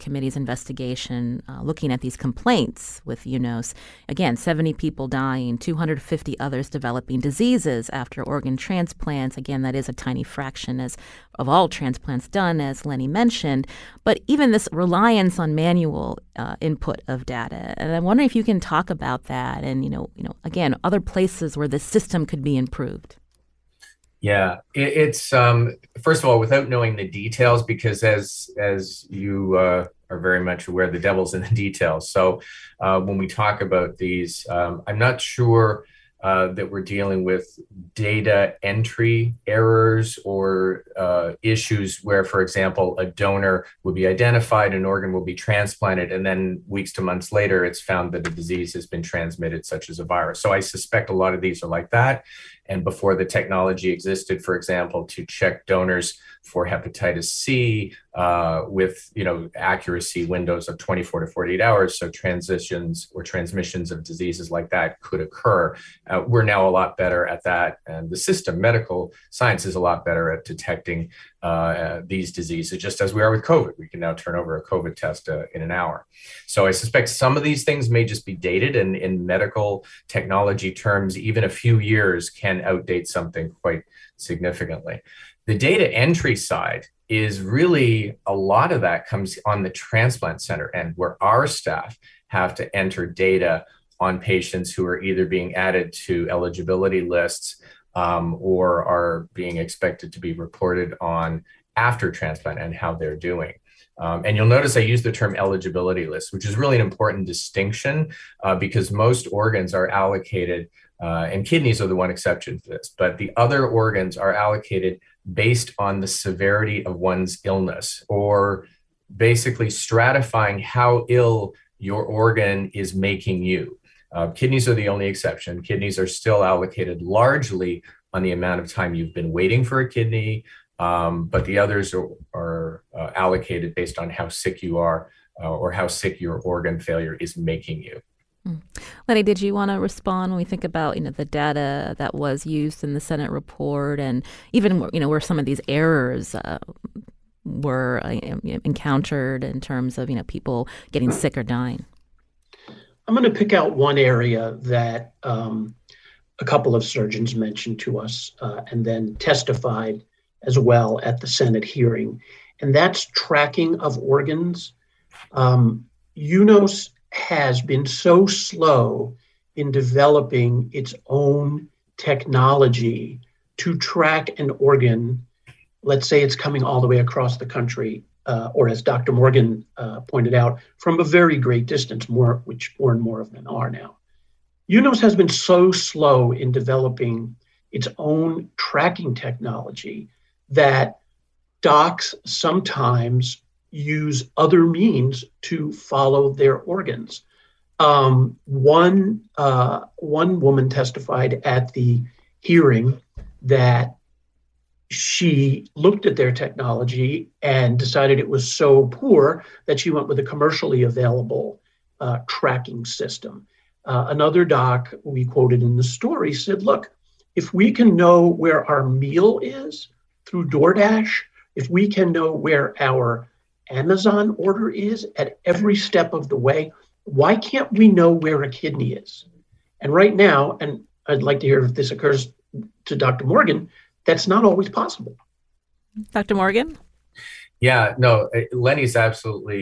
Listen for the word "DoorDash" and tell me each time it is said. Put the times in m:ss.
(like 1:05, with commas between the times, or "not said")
3:40.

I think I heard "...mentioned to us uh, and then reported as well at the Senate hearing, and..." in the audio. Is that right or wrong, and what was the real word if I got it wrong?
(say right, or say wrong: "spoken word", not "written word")
wrong: "testified", not "reported".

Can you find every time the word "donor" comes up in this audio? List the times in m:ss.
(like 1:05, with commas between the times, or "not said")
0:43, 0:55.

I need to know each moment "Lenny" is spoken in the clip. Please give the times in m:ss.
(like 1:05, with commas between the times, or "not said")
0:12, 2:19, 3:58.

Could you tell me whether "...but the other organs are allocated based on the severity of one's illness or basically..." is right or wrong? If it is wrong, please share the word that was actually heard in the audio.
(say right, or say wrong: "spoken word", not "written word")
right.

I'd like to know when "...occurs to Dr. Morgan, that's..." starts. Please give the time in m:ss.
3:51.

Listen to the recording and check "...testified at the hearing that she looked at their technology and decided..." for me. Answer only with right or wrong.
right.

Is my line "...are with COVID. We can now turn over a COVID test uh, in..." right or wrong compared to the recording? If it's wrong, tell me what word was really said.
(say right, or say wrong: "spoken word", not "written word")
right.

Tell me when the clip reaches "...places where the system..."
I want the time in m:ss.
0:20.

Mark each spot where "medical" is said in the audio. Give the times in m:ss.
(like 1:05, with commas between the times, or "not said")
1:08, 1:19.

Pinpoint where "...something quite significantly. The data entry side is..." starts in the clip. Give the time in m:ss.
1:23.